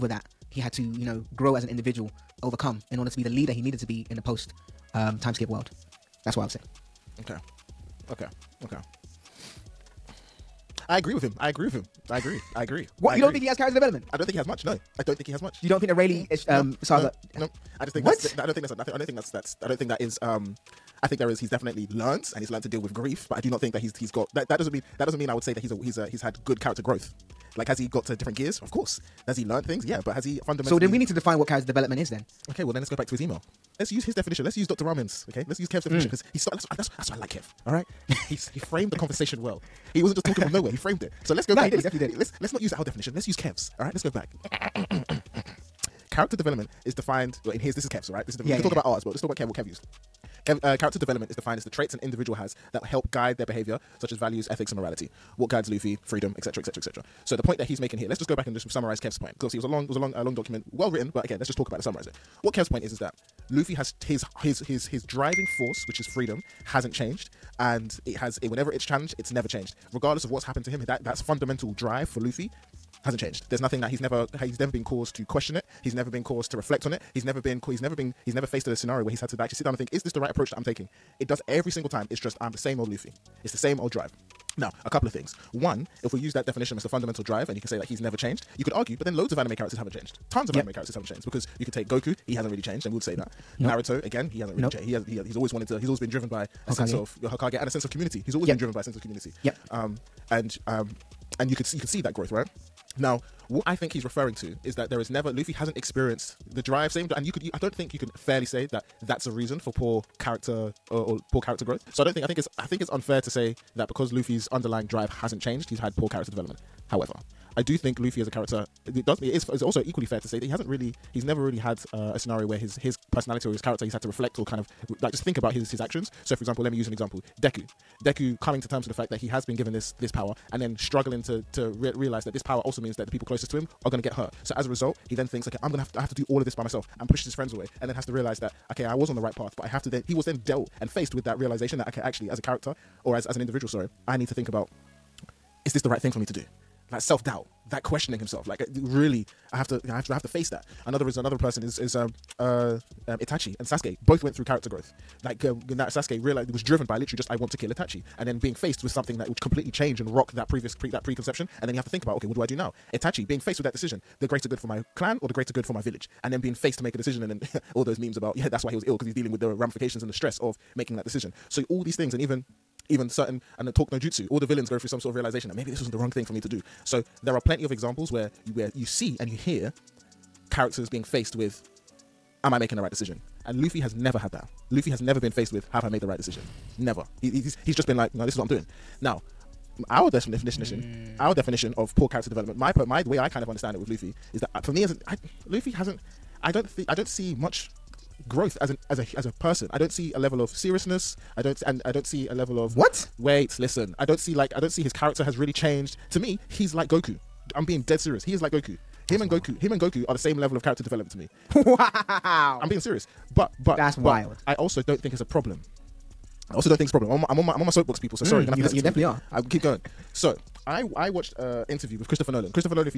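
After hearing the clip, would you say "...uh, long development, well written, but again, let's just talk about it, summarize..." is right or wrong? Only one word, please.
wrong.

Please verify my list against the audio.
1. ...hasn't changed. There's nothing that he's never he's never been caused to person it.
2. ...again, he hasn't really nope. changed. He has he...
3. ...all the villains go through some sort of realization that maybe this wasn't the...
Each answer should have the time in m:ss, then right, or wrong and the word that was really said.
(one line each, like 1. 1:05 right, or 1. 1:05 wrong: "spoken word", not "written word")
1. 1:13 wrong: "question", not "person"
2. 1:34 right
3. 2:54 right.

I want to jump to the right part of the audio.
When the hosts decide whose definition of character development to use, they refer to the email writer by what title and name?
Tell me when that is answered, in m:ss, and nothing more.
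0:34.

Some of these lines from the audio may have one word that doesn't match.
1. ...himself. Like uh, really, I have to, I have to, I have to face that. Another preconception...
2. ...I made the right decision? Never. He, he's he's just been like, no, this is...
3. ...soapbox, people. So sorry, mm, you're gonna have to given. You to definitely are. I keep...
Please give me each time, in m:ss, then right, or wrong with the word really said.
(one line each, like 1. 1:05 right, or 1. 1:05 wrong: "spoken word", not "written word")
1. 2:28 wrong: "reason", not "preconception"
2. 3:05 right
3. 3:37 wrong: "listen", not "given".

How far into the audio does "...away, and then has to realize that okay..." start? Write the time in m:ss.
2:17.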